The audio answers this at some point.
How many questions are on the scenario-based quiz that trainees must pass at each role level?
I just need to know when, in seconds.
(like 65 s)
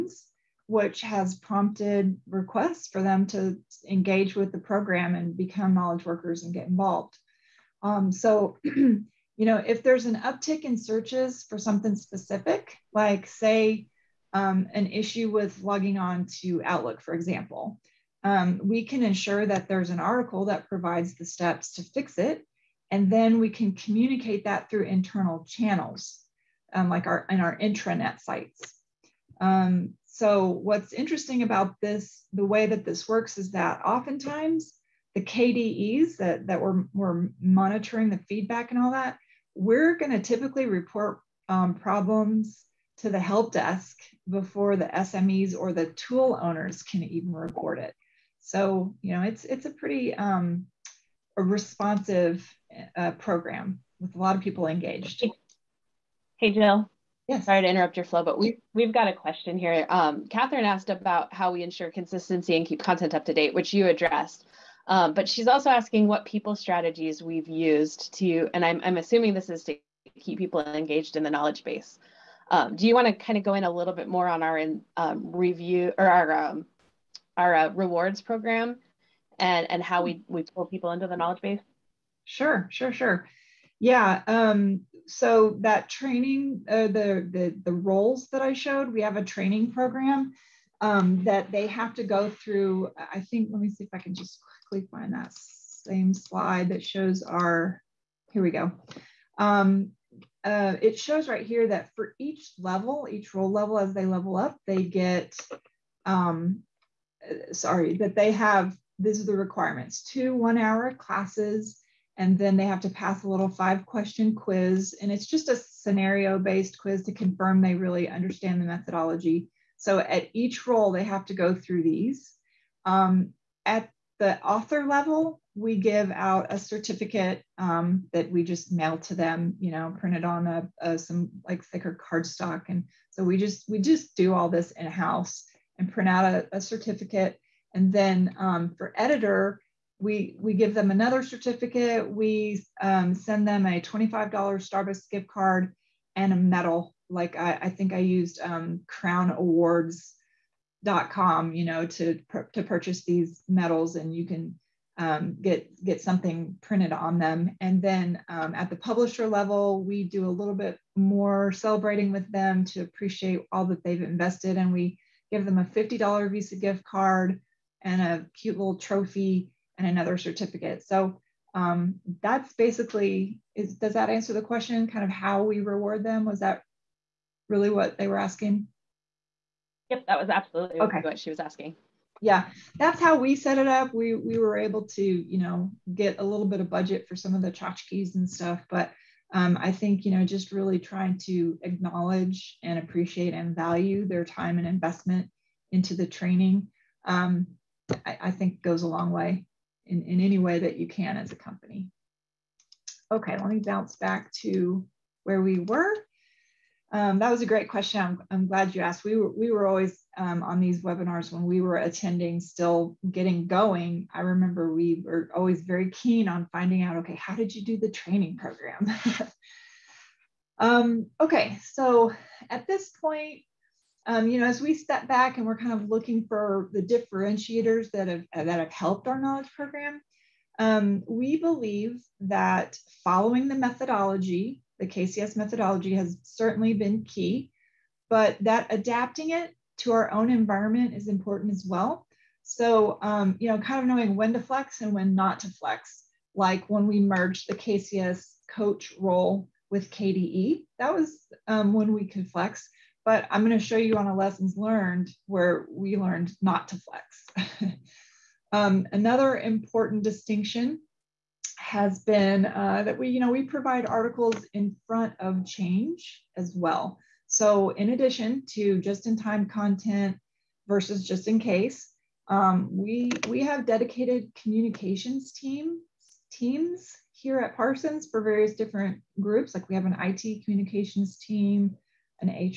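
113 s.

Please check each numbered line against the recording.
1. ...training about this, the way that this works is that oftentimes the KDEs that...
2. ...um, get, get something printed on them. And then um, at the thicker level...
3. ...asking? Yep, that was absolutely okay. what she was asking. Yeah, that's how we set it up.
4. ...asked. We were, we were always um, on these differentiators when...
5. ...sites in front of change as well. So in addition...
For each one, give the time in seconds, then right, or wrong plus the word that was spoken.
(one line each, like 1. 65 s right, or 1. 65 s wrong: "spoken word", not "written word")
1. 30 s wrong: "interesting", not "training"
2. 154 s wrong: "publisher", not "thicker"
3. 178 s right
4. 208 s wrong: "webinars", not "differentiators"
5. 263 s wrong: "articles", not "sites".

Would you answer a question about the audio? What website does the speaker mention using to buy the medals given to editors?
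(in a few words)
crownawards.com.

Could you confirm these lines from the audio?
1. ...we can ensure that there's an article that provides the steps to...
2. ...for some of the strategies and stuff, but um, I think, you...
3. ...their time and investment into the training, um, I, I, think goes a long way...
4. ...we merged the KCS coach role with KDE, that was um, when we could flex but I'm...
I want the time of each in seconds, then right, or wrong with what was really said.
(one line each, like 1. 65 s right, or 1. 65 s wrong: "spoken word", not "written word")
1. 18 s right
2. 187 s wrong: "tchotchkes", not "strategies"
3. 194 s right
4. 246 s right.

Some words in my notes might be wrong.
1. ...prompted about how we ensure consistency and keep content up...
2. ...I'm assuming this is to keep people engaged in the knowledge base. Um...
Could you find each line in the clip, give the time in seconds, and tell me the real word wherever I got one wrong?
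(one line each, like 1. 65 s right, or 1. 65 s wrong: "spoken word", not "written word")
1. 60 s wrong: "asked", not "prompted"
2. 68 s right.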